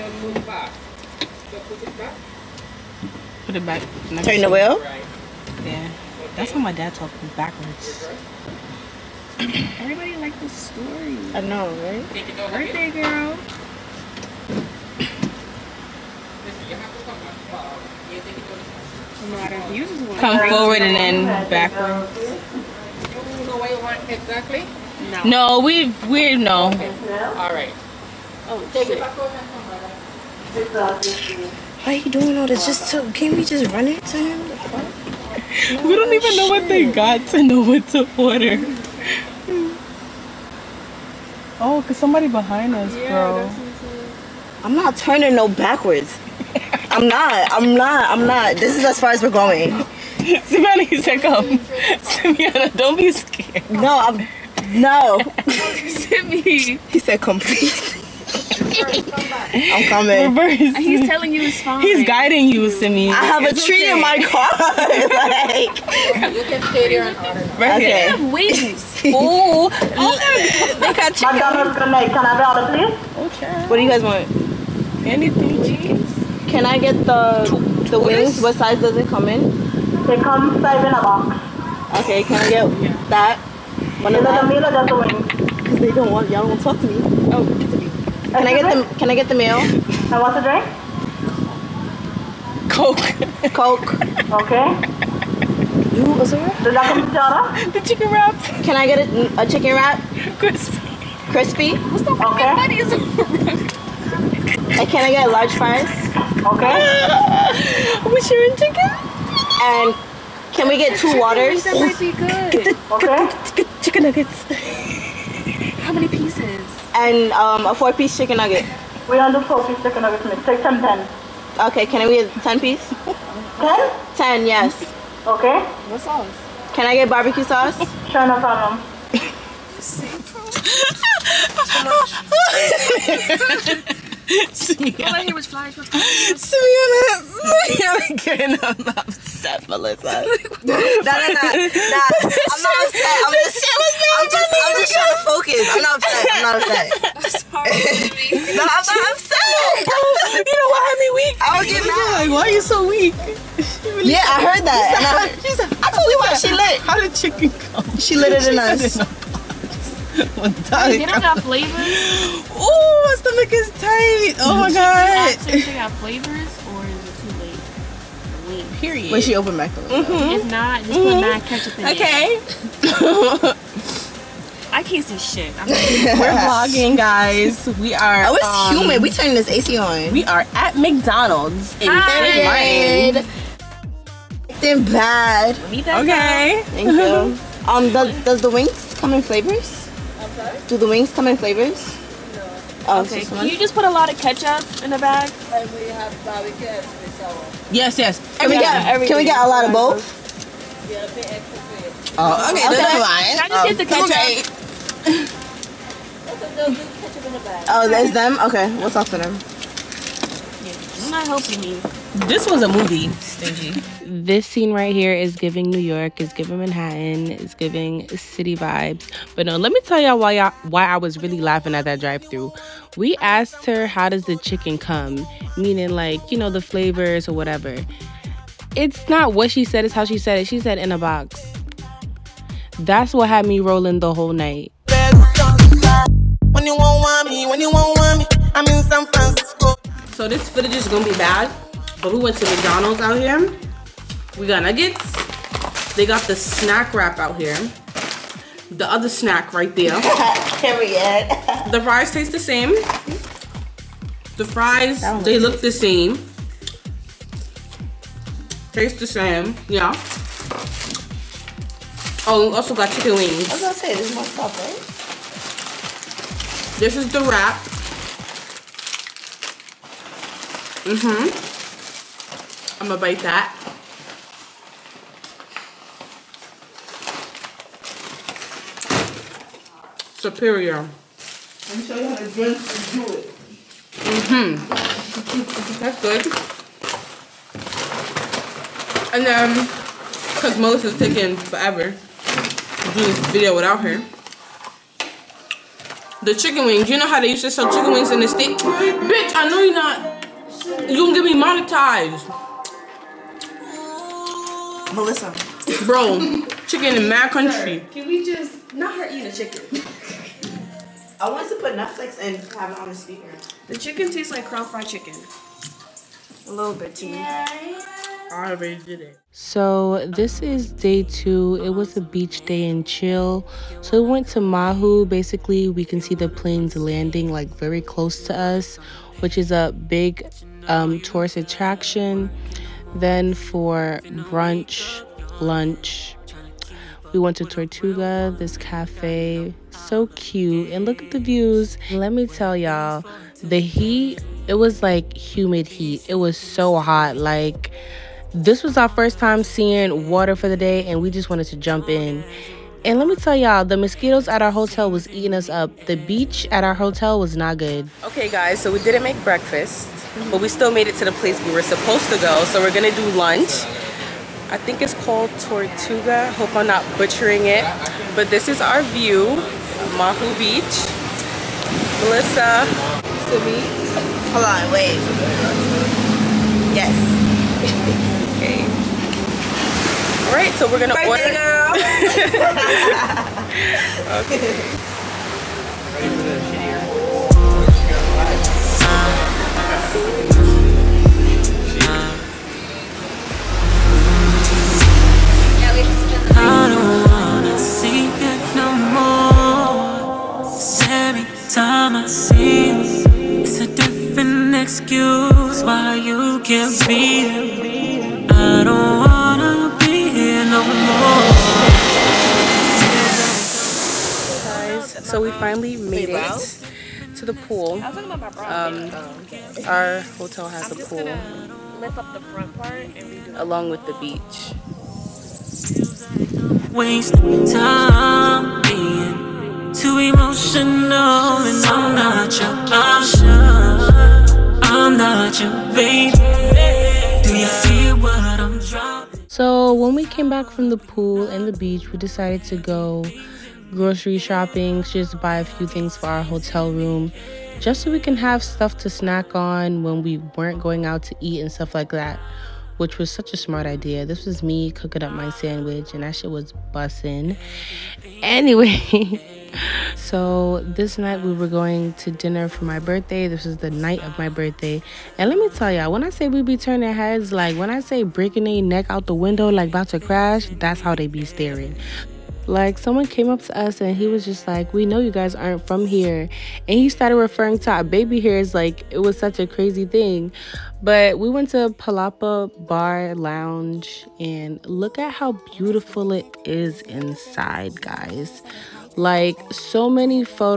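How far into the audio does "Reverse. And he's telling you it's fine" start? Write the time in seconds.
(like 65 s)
60 s.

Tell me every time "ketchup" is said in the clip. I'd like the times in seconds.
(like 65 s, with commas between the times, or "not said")
171 s, 194 s, 207 s.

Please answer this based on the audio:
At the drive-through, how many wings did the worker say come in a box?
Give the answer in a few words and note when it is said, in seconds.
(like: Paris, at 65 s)
5, at 80 s.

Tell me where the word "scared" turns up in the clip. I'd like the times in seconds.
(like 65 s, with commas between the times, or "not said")
53 s.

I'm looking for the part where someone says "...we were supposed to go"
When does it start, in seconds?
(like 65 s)
361 s.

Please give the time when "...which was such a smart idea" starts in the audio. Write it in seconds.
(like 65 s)
452 s.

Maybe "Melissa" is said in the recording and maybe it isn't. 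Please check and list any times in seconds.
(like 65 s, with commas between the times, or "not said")
139 s, 290 s, 304 s, 372 s.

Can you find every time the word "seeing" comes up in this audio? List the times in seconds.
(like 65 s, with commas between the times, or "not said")
349 s.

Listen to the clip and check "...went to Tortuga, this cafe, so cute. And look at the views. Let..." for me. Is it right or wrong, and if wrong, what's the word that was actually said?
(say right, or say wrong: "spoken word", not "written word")
right.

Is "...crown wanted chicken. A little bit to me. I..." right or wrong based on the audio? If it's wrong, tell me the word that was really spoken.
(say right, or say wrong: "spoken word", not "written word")
wrong: "fried", not "wanted".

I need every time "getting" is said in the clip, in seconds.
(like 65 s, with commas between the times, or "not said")
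138 s, 151 s.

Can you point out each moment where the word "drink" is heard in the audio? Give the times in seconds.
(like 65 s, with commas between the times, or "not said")
90 s, 282 s.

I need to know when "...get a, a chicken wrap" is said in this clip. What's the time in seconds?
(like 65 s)
98 s.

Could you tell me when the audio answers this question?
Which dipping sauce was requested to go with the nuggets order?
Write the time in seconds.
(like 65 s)
127 s.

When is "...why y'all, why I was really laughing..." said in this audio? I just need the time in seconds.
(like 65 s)
220 s.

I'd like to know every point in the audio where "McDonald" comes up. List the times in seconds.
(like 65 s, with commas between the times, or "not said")
180 s, 242 s.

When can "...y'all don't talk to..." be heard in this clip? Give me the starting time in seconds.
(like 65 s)
86 s.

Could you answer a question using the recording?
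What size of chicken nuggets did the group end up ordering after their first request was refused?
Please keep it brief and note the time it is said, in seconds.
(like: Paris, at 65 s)
10-piece, at 122 s.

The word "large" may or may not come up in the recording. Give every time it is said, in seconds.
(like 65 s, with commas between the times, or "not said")
105 s.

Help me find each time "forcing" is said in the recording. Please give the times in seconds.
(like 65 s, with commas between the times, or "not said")
not said.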